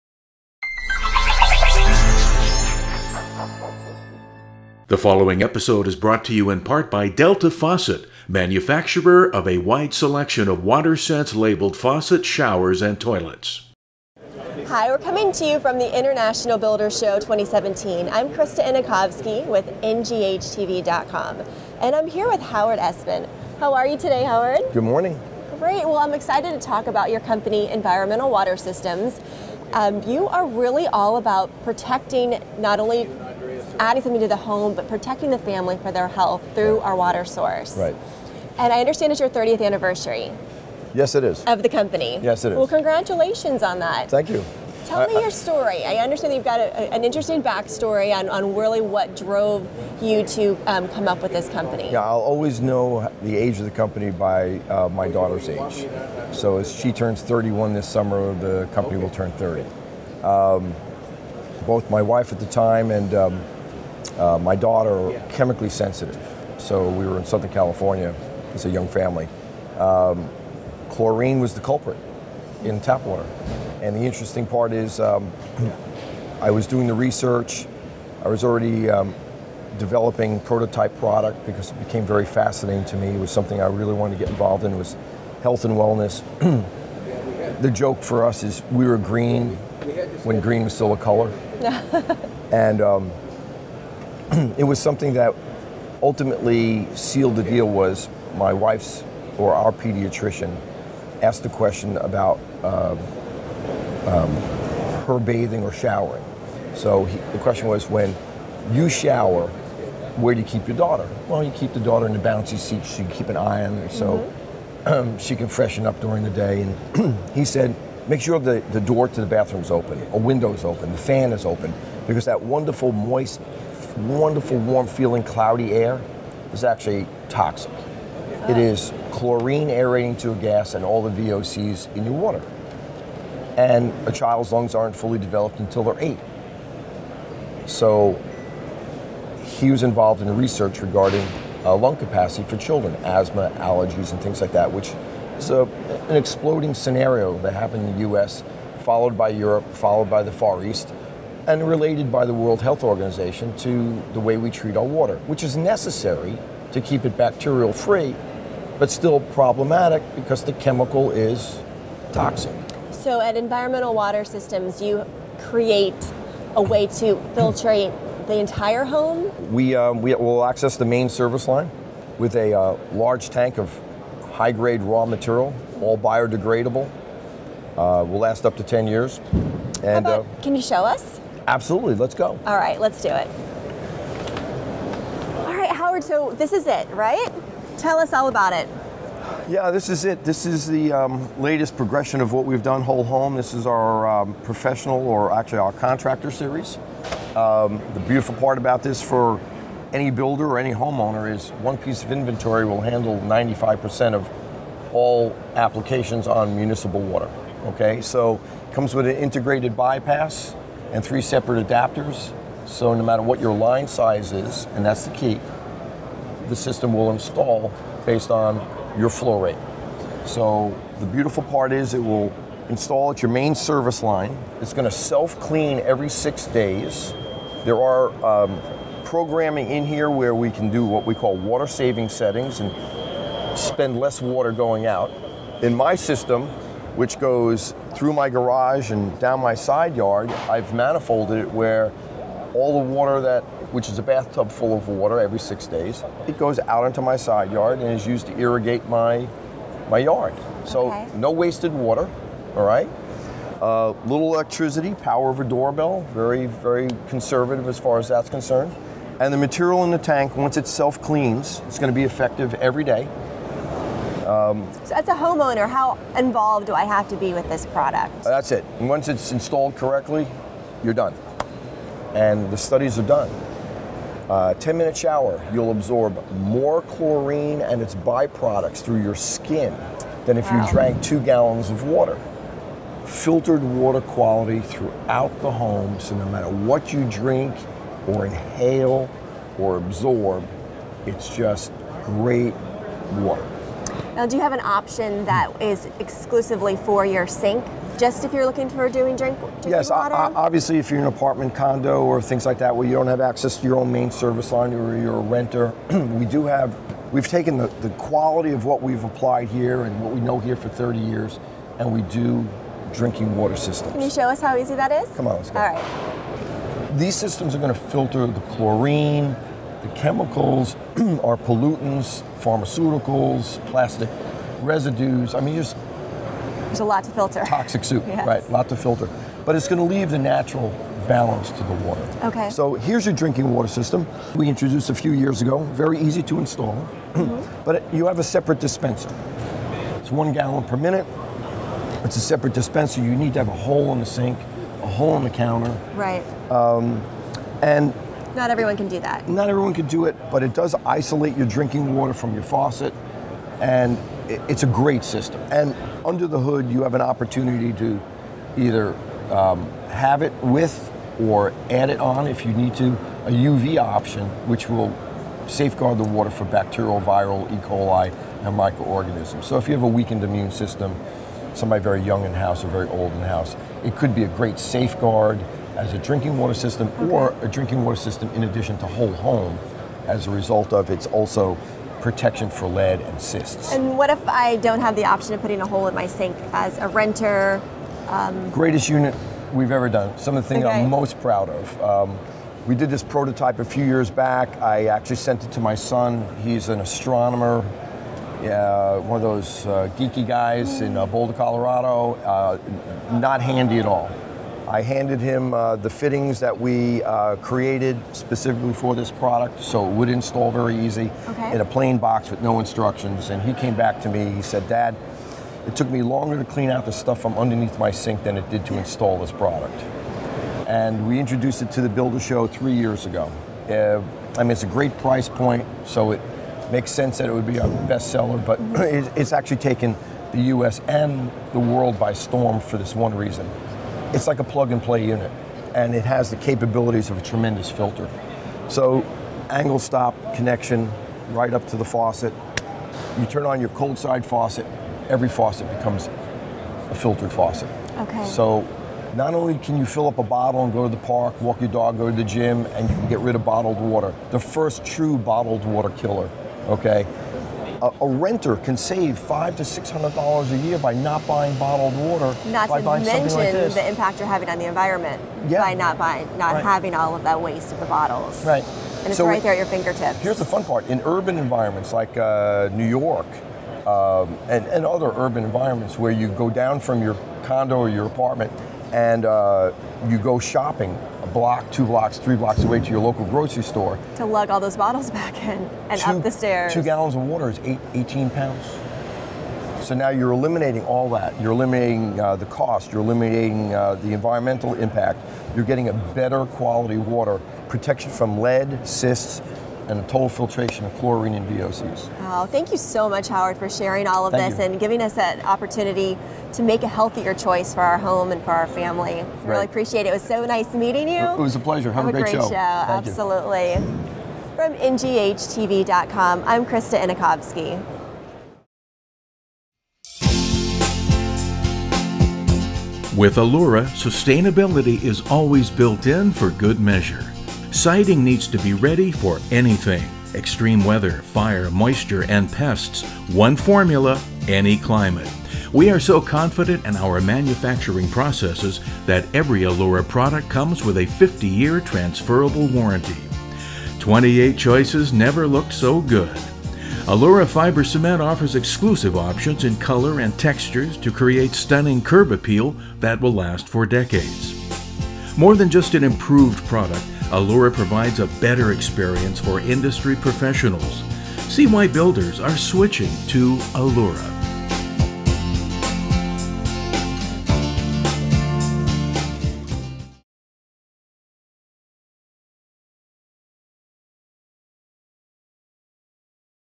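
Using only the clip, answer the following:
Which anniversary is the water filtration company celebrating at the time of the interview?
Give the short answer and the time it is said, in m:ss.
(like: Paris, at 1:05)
30th, at 0:39.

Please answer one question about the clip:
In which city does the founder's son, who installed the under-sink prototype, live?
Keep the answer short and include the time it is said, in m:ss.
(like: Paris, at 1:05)
Boulder, Colorado, at 6:41.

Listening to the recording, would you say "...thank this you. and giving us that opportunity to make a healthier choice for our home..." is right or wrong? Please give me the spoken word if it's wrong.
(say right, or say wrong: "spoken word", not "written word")
right.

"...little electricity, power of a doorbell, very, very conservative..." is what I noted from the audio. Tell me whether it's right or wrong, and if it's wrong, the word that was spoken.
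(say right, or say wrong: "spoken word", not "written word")
right.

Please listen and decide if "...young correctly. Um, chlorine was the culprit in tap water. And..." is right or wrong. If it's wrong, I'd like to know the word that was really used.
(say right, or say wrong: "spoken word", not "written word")
wrong: "family", not "correctly".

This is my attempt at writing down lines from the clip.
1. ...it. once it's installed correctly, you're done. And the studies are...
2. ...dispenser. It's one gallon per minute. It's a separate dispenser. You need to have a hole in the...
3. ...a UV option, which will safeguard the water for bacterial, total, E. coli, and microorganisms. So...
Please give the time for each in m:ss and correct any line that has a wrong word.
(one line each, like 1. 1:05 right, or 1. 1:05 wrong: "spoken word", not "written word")
1. 4:28 right
2. 5:38 right
3. 6:03 wrong: "viral", not "total".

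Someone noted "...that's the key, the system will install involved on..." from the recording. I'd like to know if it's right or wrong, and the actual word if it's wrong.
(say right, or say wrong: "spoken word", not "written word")
wrong: "based", not "involved".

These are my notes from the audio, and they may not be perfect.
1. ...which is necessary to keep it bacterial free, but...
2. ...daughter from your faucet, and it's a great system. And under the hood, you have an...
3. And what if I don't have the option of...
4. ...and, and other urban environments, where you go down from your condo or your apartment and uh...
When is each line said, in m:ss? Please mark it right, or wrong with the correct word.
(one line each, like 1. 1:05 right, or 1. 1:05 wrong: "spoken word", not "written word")
1. 2:35 right
2. 5:51 wrong: "water", not "daughter"
3. 6:23 right
4. 7:54 right.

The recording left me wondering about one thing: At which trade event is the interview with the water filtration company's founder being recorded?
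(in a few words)
International Builders Show 2017.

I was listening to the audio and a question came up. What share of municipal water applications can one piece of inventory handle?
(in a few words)
95%.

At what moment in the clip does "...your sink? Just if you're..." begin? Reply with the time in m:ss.
4:57.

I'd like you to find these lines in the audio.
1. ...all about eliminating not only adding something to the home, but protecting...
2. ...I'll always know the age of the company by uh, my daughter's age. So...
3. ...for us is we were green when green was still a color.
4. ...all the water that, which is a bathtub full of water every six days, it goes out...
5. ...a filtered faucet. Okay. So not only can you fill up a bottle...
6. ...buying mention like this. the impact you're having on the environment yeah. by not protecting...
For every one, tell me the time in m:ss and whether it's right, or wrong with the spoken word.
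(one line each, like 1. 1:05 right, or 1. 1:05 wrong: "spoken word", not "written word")
1. 0:30 wrong: "protecting", not "eliminating"
2. 0:52 right
3. 1:28 right
4. 4:02 right
5. 7:26 right
6. 7:42 wrong: "buying", not "protecting".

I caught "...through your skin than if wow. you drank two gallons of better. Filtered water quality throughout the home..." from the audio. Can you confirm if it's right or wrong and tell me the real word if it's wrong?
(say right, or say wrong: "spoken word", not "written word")
wrong: "water", not "better".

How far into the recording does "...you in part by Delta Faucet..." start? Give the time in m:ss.
0:06.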